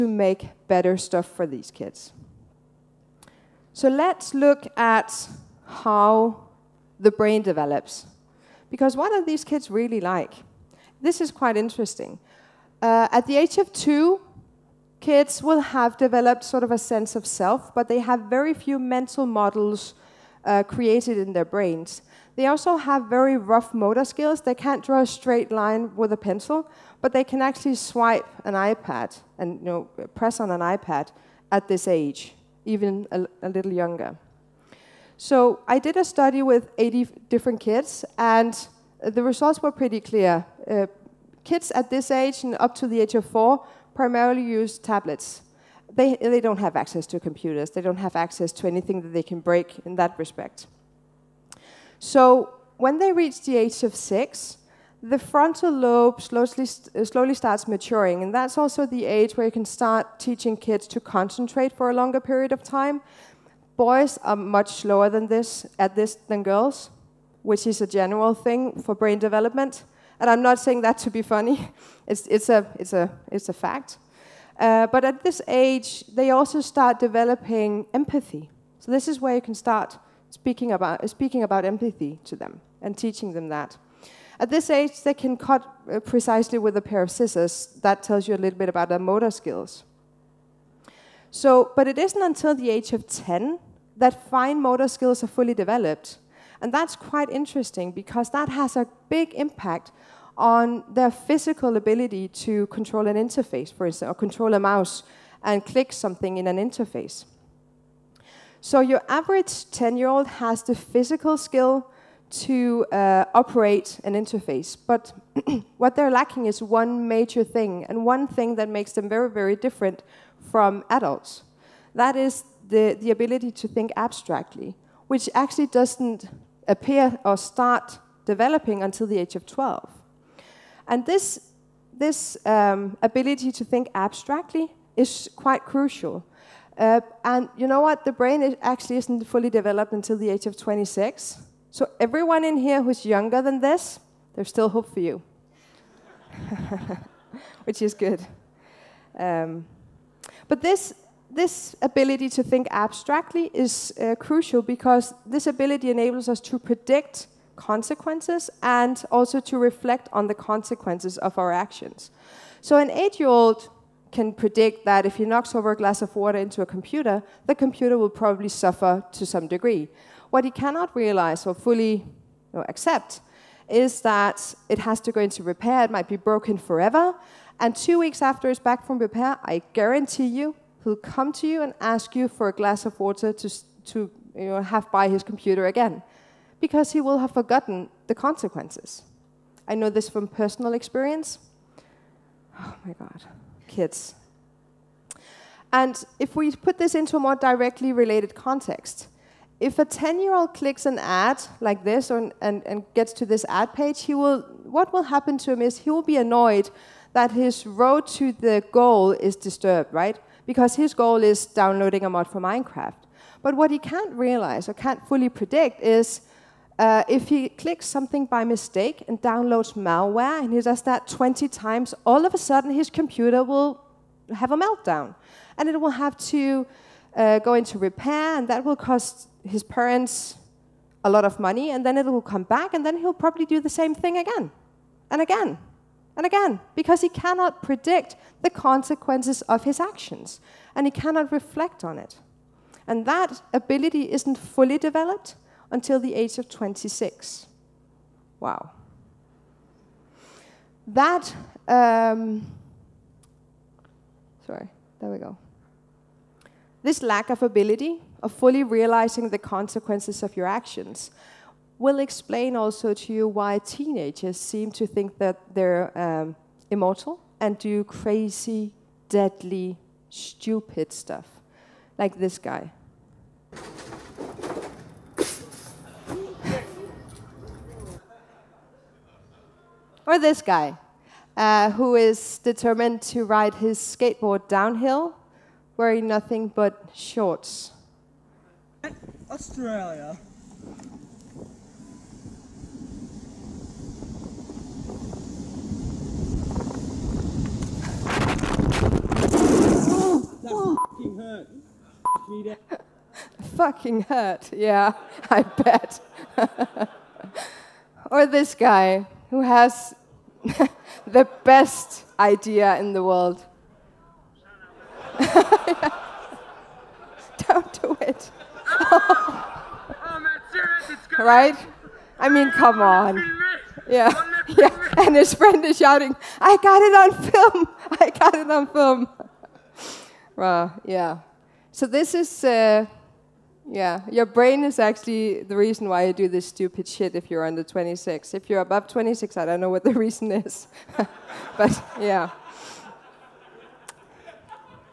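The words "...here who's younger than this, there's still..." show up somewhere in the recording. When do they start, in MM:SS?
02:22.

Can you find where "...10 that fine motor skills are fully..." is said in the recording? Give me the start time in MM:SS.
01:33.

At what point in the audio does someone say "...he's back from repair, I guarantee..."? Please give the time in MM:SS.
02:58.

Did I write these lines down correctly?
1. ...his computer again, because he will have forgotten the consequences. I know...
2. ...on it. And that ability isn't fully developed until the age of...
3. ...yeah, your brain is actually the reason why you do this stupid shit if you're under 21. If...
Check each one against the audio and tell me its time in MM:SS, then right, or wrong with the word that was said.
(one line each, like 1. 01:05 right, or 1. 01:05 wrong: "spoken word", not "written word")
1. 03:05 right
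2. 04:01 right
3. 05:33 wrong: "26", not "21".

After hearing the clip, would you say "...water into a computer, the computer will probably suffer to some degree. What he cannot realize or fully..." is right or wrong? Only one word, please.
right.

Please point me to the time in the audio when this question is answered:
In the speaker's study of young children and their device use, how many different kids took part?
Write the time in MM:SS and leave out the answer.
00:36.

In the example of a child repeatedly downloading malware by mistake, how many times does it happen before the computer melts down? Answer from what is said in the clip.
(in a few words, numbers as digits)
20.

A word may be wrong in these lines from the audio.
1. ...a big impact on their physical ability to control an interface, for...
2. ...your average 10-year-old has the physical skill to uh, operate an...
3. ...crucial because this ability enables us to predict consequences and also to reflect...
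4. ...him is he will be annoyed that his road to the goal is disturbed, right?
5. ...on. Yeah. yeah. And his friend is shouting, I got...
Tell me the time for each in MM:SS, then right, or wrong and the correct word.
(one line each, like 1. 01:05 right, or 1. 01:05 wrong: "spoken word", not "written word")
1. 01:38 right
2. 01:48 right
3. 02:34 right
4. 03:25 right
5. 05:22 right.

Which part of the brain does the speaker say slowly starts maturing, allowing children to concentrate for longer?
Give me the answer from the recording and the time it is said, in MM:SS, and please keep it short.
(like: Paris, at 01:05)
Frontal lobe, at 00:55.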